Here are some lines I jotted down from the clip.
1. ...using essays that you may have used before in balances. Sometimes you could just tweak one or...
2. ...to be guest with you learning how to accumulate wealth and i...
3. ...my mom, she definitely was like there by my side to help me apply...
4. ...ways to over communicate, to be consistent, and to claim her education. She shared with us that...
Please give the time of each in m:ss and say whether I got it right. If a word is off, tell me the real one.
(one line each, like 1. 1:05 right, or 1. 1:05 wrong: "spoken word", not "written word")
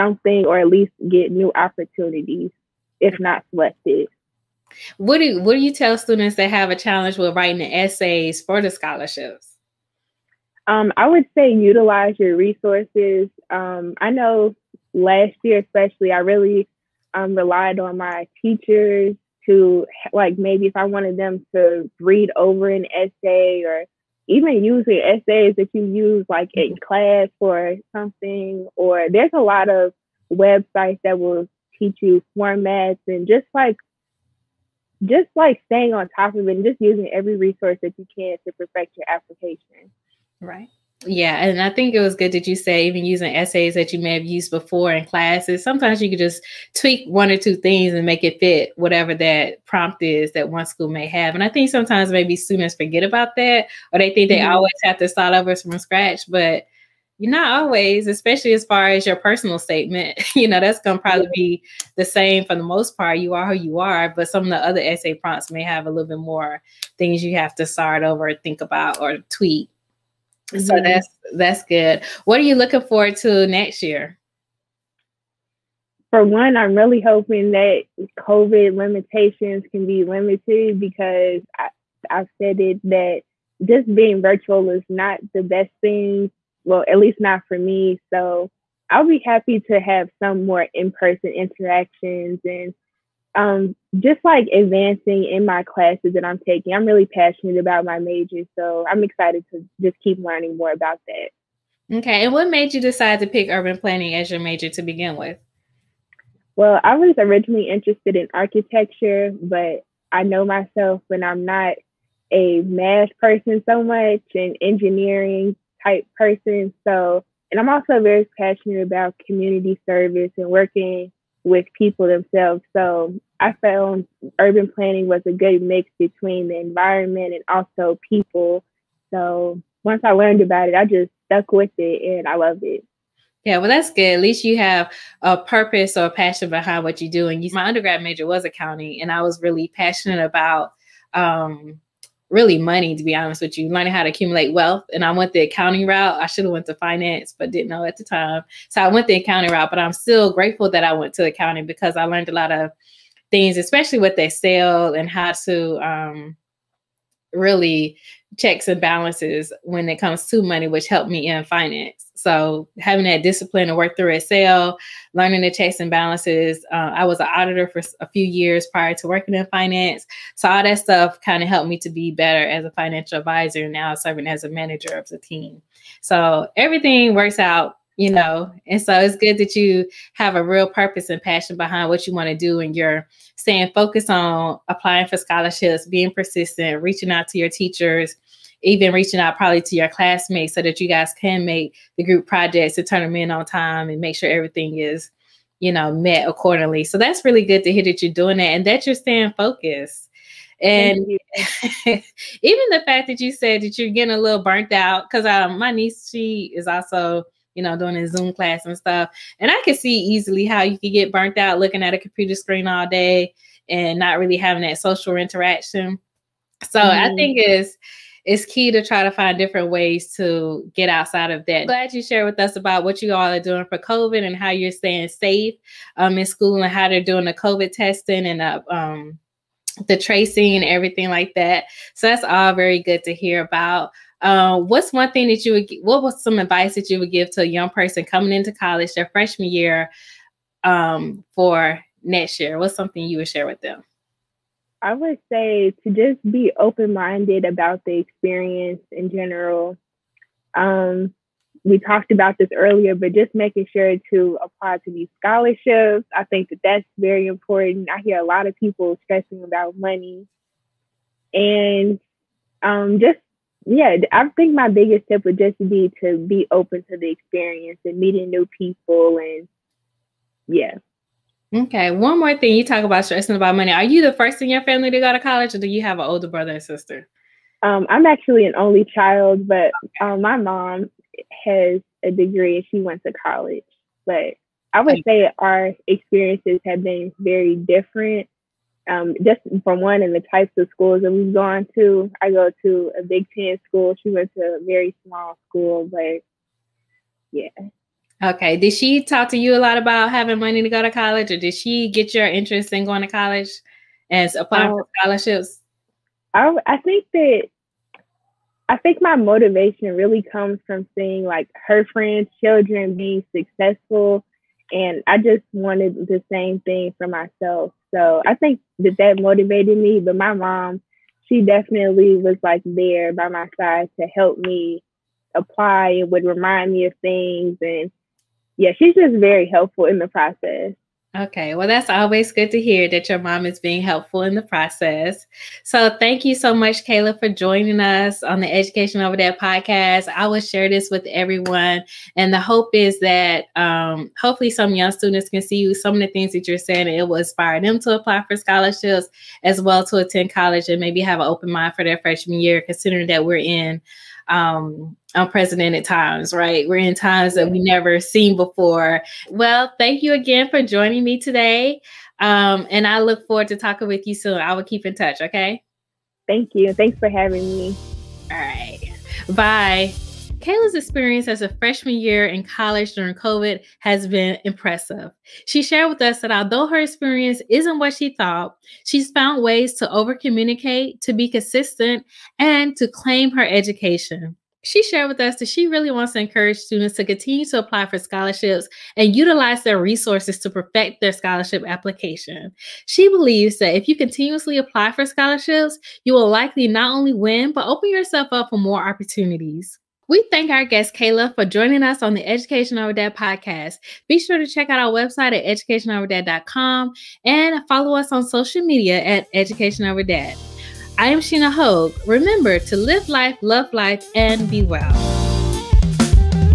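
1. 0:43 wrong: "classes", not "balances"
2. 2:22 wrong: "honest", not "guest"
3. 5:20 right
4. 6:19 right.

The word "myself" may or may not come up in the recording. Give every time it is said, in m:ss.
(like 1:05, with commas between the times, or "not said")
1:50, 5:17.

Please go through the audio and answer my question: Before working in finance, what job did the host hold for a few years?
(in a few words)
Auditor.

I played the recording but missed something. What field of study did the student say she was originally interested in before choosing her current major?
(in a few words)
Architecture.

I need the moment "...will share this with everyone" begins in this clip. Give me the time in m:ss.
5:40.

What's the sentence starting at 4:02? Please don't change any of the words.
What's something you would share with them?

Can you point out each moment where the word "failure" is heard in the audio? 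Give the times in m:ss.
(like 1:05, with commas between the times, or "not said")
not said.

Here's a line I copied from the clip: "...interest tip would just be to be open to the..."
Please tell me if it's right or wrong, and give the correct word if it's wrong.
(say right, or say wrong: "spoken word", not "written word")
wrong: "biggest", not "interest".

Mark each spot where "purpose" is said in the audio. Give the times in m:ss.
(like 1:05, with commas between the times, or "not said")
2:15, 3:00.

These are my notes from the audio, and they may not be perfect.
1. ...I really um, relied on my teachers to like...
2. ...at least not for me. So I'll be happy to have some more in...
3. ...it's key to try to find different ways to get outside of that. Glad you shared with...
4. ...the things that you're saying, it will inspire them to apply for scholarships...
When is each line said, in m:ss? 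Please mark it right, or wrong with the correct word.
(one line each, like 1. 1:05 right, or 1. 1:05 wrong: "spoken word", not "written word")
1. 0:16 right
2. 1:26 right
3. 3:38 right
4. 5:46 right.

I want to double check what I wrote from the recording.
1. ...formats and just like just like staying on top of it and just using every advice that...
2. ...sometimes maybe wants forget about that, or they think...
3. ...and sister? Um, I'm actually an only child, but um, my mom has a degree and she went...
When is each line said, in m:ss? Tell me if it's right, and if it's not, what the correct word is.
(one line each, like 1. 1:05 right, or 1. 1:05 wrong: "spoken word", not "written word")
1. 0:32 wrong: "resource", not "advice"
2. 0:51 wrong: "students", not "wants"
3. 4:36 right.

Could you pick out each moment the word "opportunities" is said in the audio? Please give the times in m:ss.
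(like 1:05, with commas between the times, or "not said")
0:01, 6:38.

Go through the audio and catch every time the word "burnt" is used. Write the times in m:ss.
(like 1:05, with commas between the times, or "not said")
3:24, 3:31.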